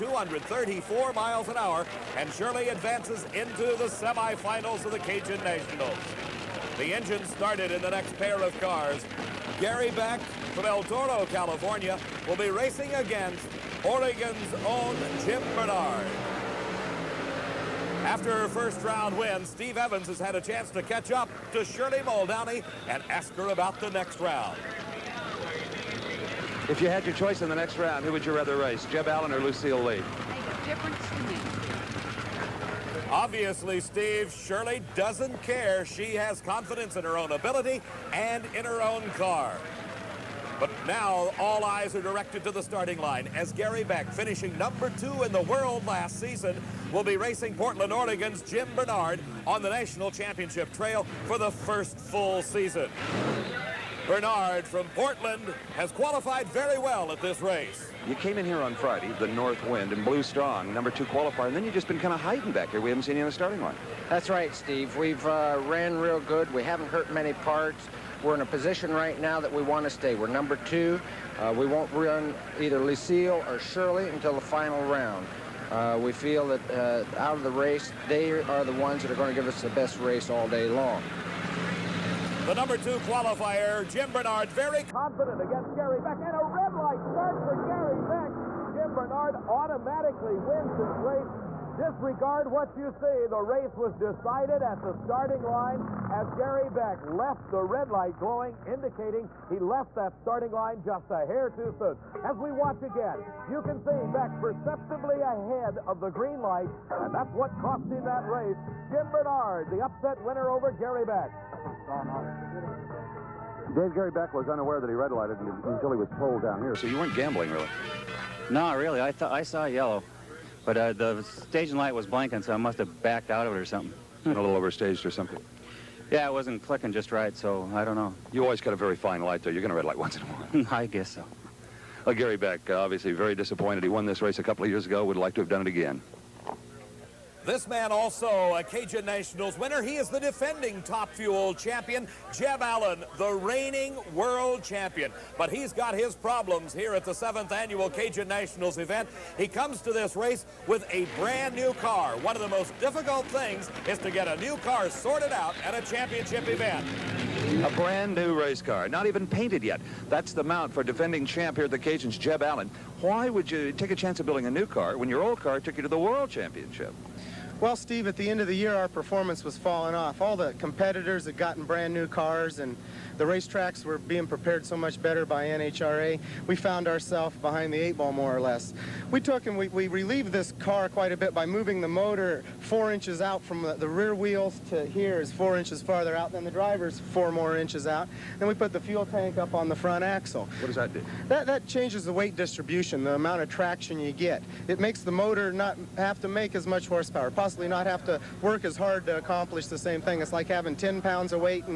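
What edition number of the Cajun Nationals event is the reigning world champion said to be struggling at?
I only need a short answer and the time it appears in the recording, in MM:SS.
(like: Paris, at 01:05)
7th, at 02:27.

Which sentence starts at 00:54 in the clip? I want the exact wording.
Bernard from Portland has qualified very well at this race.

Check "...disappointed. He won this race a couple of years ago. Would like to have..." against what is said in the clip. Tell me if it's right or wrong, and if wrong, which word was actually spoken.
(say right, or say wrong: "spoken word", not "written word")
right.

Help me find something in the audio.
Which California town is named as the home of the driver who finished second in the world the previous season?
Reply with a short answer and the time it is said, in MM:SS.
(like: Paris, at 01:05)
El Toro, at 00:10.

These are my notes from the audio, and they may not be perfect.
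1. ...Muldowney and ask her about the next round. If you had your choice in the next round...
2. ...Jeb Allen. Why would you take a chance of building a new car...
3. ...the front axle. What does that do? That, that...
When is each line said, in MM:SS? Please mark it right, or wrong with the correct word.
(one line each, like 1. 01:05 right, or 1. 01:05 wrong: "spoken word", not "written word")
1. 00:21 right
2. 02:42 right
3. 03:09 right.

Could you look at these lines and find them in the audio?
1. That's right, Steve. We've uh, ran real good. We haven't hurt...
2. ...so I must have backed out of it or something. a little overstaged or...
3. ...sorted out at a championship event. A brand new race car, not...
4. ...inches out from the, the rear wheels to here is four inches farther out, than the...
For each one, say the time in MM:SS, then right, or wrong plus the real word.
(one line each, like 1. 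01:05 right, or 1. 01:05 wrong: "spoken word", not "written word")
1. 01:04 right
2. 02:02 right
3. 02:34 right
4. 03:02 right.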